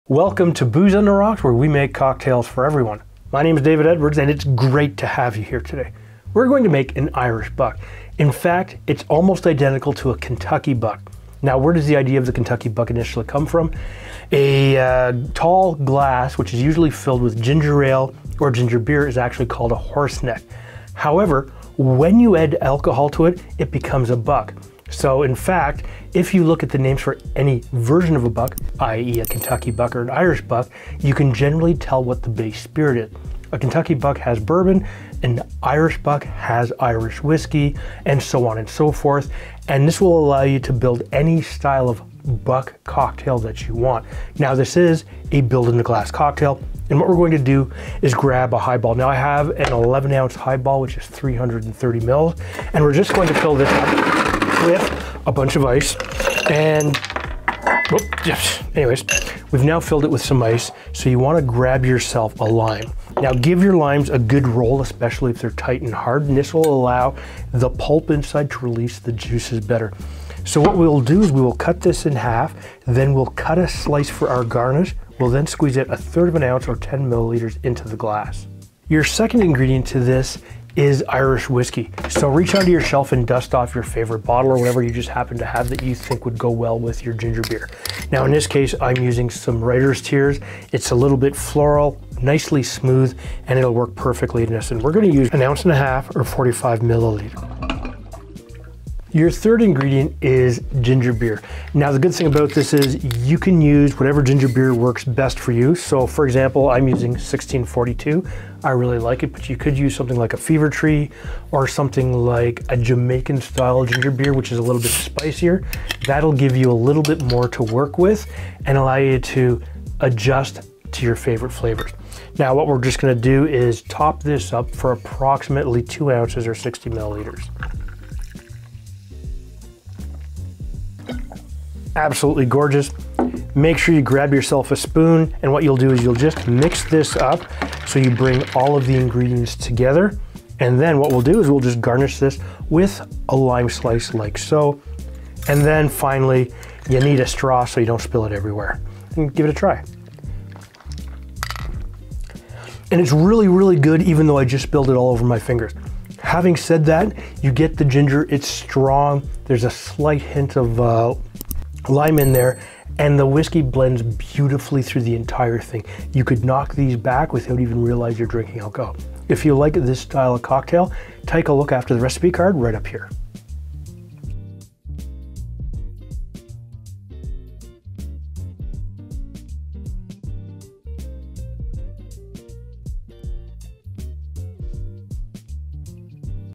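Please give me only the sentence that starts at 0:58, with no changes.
anyways, we've now filled it with some ice.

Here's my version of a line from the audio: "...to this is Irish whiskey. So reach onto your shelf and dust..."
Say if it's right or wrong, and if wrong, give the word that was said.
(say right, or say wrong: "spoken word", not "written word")
right.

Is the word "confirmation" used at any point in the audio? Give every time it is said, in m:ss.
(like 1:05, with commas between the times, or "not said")
not said.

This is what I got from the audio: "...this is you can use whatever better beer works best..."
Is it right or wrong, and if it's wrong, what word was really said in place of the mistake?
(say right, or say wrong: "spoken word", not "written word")
wrong: "ginger", not "better".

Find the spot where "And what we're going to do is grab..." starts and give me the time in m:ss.
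0:46.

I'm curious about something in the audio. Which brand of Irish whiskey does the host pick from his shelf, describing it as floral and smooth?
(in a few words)
Writer's Tears.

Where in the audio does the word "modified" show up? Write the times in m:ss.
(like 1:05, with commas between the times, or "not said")
not said.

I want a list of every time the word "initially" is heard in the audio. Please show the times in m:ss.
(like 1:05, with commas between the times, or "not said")
0:12.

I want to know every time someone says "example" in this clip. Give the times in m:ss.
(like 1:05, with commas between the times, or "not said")
1:46.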